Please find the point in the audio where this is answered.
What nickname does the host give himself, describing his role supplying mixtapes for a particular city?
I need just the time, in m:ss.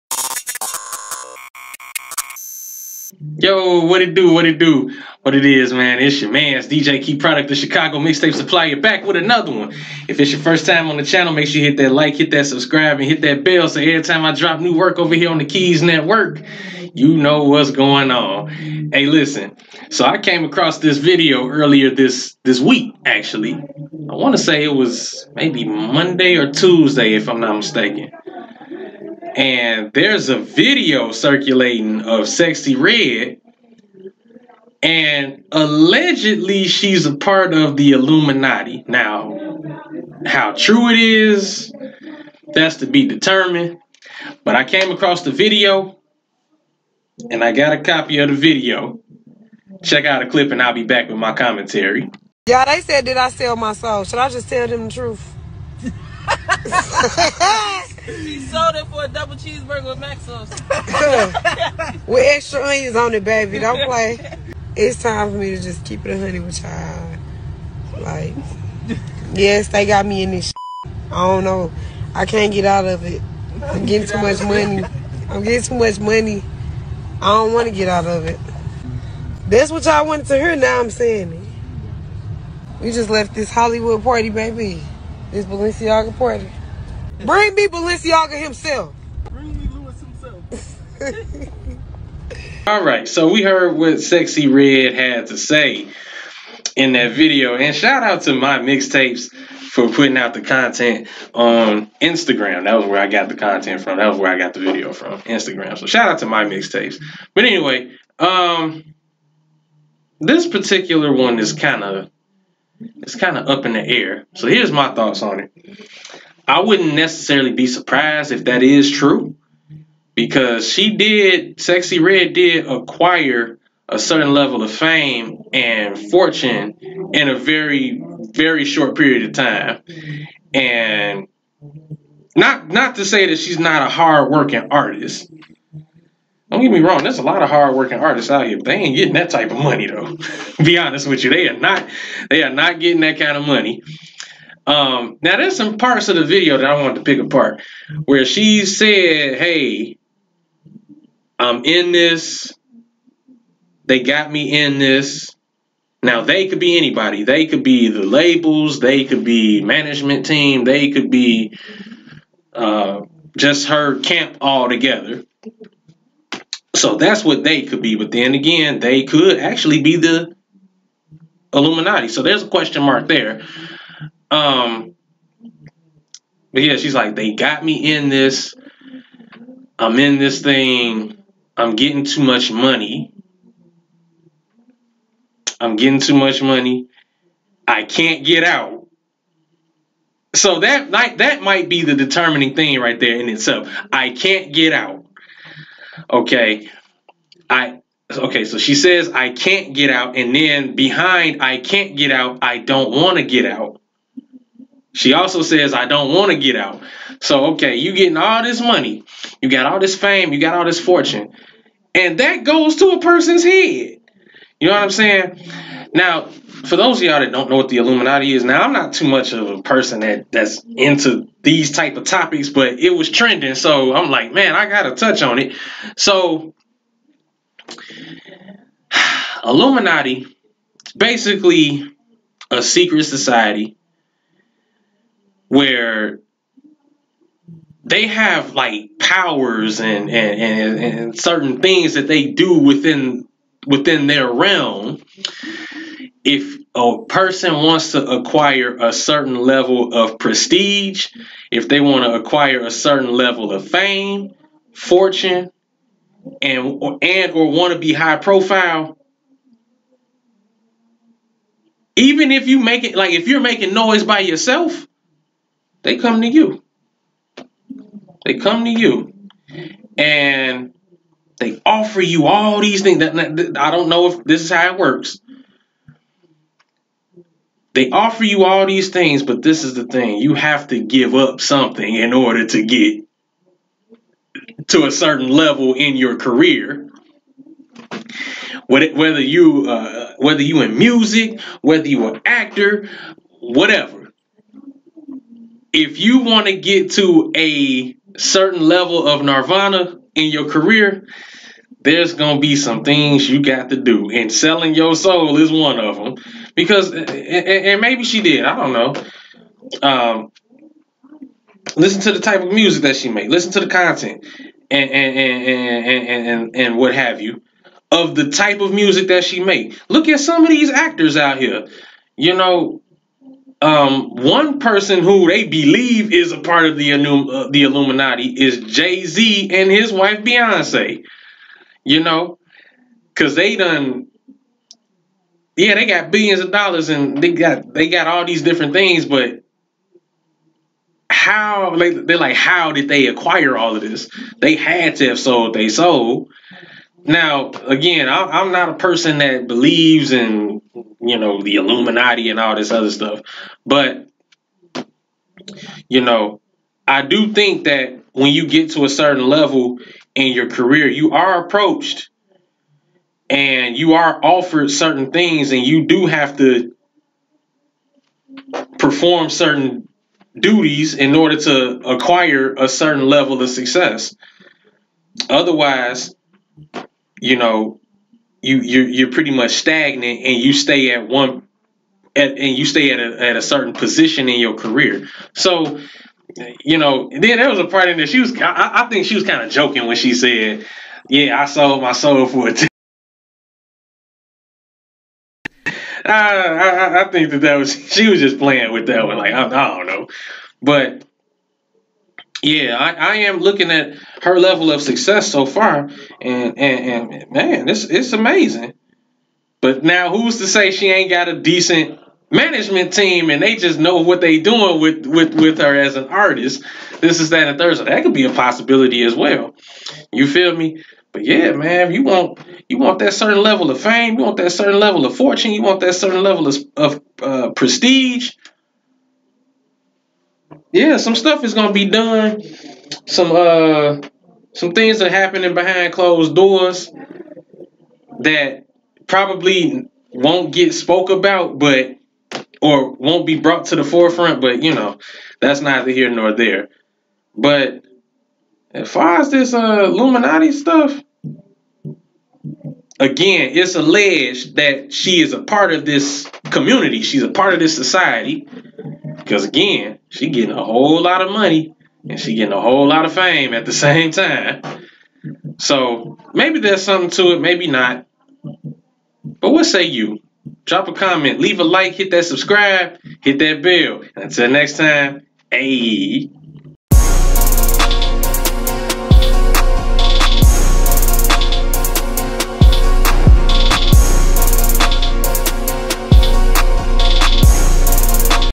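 0:07.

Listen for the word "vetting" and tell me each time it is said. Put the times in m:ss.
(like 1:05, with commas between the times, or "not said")
not said.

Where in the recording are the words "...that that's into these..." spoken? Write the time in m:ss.
3:40.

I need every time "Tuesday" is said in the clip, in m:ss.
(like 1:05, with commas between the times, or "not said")
0:26.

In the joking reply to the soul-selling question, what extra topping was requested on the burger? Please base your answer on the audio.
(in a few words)
extra onions.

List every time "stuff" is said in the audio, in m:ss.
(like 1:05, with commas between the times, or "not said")
5:52, 7:11, 7:30.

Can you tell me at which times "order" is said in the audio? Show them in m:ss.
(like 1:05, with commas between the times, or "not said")
4:42, 6:11.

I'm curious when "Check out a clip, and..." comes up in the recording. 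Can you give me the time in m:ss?
0:49.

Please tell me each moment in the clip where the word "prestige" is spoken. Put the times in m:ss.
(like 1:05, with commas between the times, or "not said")
4:10, 7:07.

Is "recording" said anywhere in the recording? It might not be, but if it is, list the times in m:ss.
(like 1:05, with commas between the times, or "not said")
not said.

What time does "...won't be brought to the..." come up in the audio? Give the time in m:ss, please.
7:22.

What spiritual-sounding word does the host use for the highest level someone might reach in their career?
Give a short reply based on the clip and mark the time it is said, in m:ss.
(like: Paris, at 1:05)
nirvana, at 4:59.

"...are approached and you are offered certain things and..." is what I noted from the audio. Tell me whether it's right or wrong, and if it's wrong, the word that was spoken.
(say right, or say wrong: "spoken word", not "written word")
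right.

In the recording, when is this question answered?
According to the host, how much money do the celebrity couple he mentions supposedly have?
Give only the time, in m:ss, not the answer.
5:36.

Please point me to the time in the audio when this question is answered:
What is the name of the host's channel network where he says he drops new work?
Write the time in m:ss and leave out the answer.
0:15.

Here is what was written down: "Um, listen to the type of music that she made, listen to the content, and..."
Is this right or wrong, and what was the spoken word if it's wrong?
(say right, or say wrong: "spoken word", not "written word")
right.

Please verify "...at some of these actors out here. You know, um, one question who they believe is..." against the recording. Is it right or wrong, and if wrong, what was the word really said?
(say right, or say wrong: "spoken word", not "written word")
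wrong: "person", not "question".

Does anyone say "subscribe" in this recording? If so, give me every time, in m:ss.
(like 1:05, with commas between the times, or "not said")
0:12, 7:52.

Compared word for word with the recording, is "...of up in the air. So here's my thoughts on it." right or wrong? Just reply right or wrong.
right.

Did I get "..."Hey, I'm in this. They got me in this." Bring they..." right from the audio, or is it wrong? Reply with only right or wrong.
wrong.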